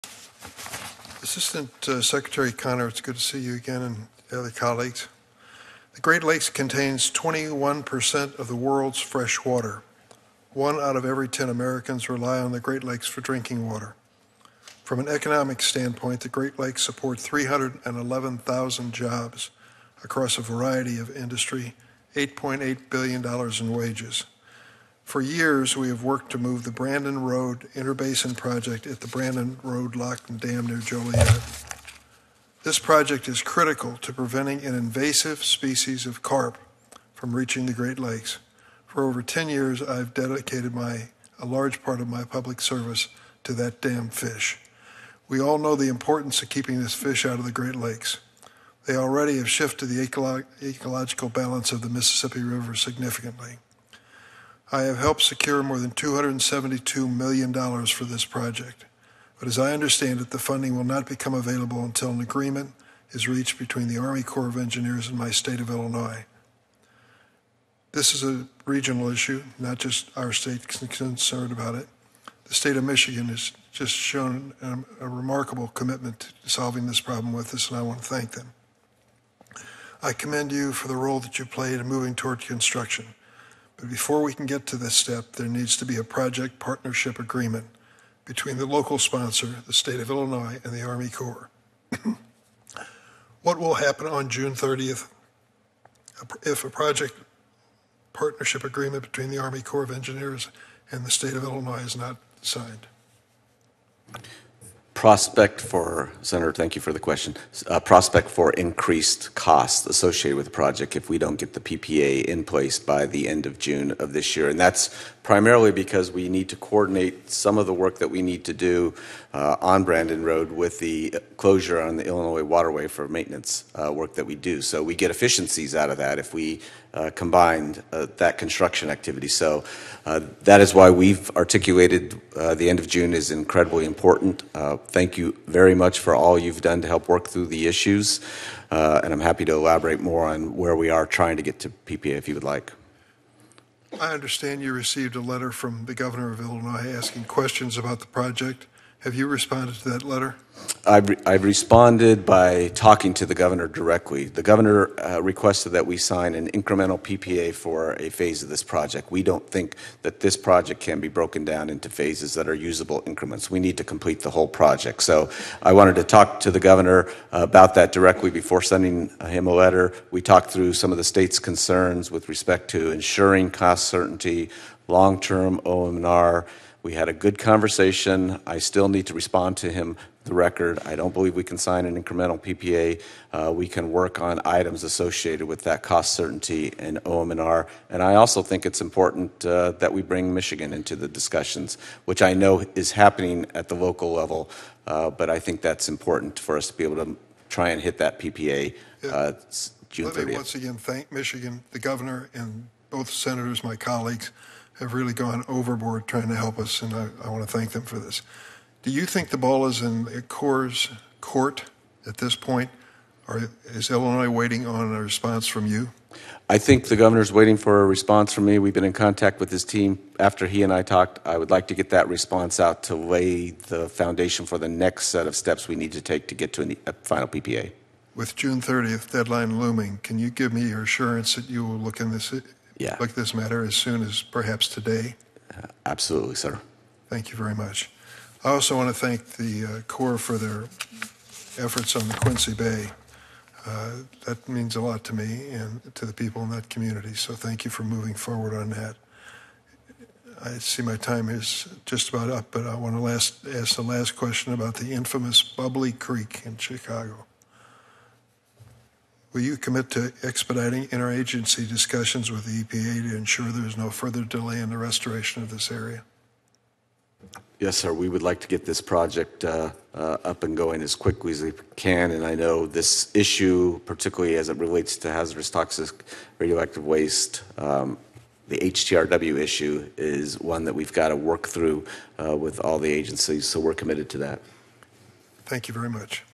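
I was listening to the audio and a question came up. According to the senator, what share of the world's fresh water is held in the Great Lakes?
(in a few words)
21%.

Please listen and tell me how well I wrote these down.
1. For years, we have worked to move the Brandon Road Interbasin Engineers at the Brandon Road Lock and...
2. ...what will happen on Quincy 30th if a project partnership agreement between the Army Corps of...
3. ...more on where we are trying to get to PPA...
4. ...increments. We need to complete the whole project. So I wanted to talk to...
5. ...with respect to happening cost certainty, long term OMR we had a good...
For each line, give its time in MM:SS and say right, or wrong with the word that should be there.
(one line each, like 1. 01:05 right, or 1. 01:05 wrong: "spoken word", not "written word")
1. 00:25 wrong: "Project", not "Engineers"
2. 01:33 wrong: "June", not "Quincy"
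3. 02:19 right
4. 02:43 right
5. 02:52 wrong: "ensuring", not "happening".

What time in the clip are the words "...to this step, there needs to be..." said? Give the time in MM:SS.
01:24.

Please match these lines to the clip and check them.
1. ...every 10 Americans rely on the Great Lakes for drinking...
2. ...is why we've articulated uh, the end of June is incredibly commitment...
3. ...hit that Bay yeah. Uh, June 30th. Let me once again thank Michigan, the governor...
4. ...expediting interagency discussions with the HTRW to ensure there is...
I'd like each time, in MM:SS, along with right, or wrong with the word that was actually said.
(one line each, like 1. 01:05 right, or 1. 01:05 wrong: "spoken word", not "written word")
1. 00:11 right
2. 02:10 wrong: "important", not "commitment"
3. 03:17 wrong: "PPA", not "Bay"
4. 04:20 wrong: "EPA", not "HTRW".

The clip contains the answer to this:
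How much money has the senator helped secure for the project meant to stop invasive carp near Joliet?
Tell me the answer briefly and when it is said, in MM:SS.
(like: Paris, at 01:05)
$272 million, at 00:55.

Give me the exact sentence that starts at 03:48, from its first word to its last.
With June 30th deadline looming, can you give me your assurance that you will look in this yeah.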